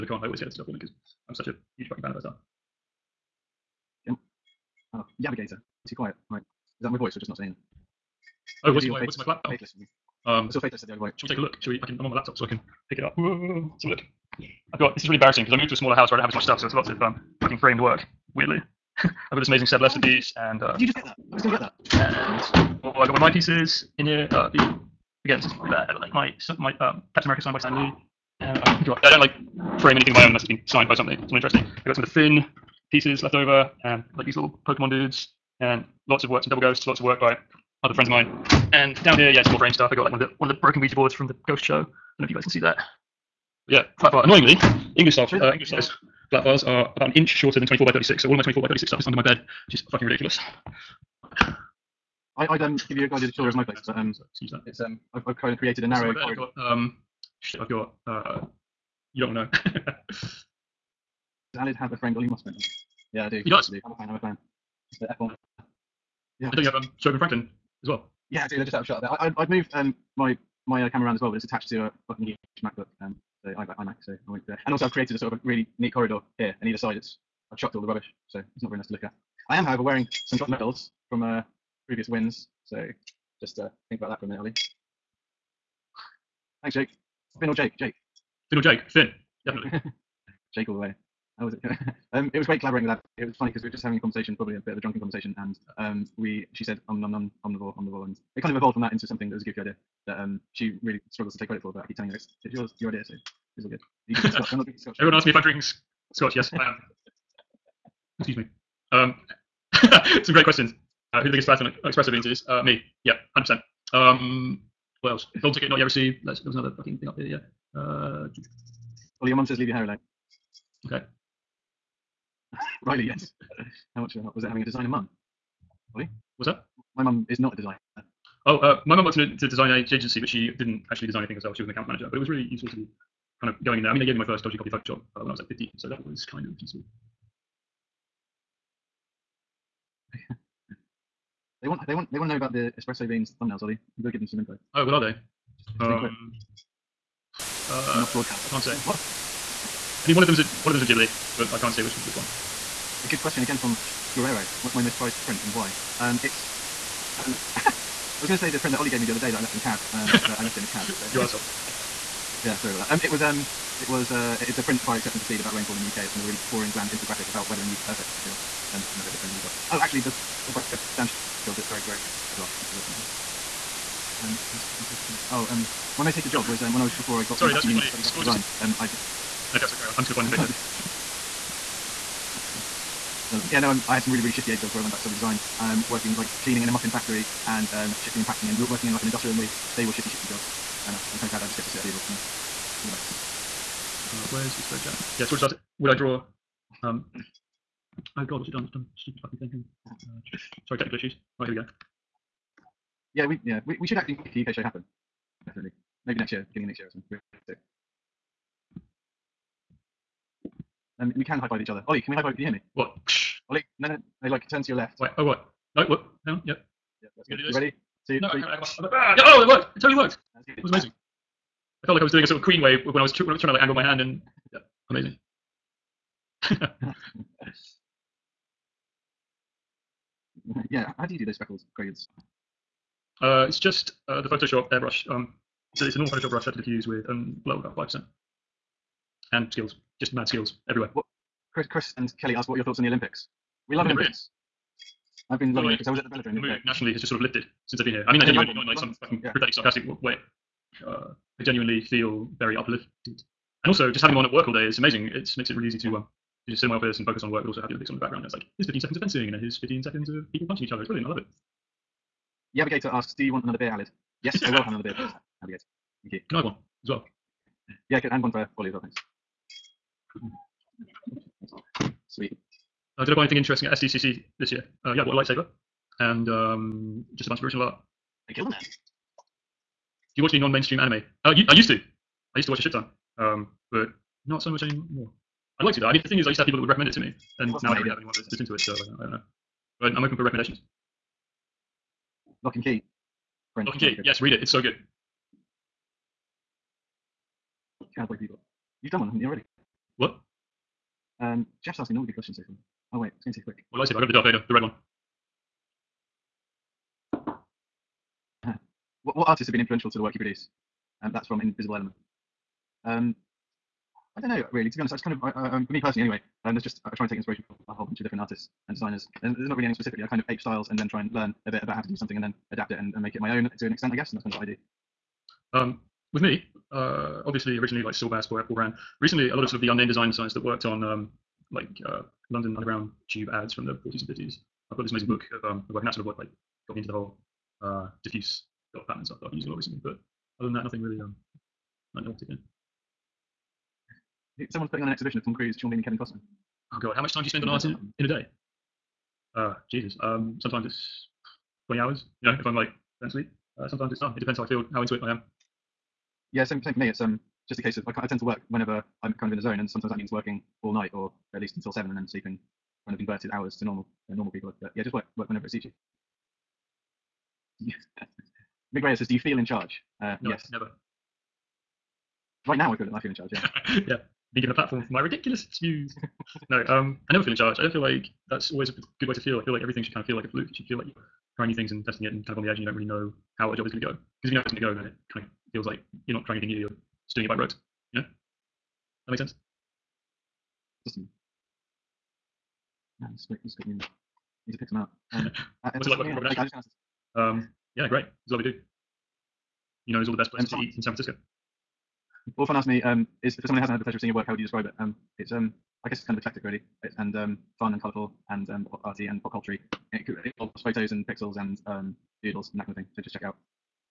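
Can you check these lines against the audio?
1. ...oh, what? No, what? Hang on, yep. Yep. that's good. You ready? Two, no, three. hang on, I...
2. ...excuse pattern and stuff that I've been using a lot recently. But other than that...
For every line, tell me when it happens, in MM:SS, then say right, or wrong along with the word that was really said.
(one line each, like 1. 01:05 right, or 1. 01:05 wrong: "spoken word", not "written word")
1. 03:35 right
2. 05:38 wrong: "diffuse", not "excuse".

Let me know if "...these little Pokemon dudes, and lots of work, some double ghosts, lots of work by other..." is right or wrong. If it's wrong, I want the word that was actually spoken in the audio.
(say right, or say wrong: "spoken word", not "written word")
right.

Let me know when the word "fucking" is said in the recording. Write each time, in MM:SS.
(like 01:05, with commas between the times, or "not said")
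00:01, 00:17, 00:49, 01:12, 01:56, 03:19, 04:09.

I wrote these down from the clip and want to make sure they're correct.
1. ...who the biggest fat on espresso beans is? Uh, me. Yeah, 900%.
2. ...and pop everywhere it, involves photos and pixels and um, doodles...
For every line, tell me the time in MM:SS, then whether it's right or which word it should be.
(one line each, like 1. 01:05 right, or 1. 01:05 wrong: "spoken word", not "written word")
1. 01:51 wrong: "100", not "900"
2. 06:49 wrong: "culture", not "everywhere".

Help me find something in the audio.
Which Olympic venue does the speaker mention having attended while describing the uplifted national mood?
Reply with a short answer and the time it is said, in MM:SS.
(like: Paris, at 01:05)
The velodrome, at 04:06.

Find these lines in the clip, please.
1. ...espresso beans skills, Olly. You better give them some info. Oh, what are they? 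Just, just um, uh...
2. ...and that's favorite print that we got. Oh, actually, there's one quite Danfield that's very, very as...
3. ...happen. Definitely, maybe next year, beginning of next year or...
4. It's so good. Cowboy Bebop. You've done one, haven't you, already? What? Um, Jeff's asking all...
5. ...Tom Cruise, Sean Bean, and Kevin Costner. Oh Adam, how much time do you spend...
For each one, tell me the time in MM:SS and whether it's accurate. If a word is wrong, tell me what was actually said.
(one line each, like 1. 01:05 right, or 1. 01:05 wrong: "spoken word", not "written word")
1. 02:22 wrong: "thumbnails", not "skills"
2. 02:48 right
3. 03:24 right
4. 04:54 right
5. 05:45 wrong: "God", not "Adam".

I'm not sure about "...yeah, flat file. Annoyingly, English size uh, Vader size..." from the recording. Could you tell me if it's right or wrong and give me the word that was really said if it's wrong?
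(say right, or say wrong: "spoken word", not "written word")
wrong: "English", not "Vader".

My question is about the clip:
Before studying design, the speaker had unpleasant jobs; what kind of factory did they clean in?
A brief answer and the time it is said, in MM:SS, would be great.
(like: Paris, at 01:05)
Muffin factory, at 03:06.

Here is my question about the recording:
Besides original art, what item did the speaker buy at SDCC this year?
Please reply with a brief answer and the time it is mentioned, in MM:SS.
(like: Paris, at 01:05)
A lightsaber, at 04:35.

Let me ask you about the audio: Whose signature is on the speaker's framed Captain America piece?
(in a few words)
Stan Lee.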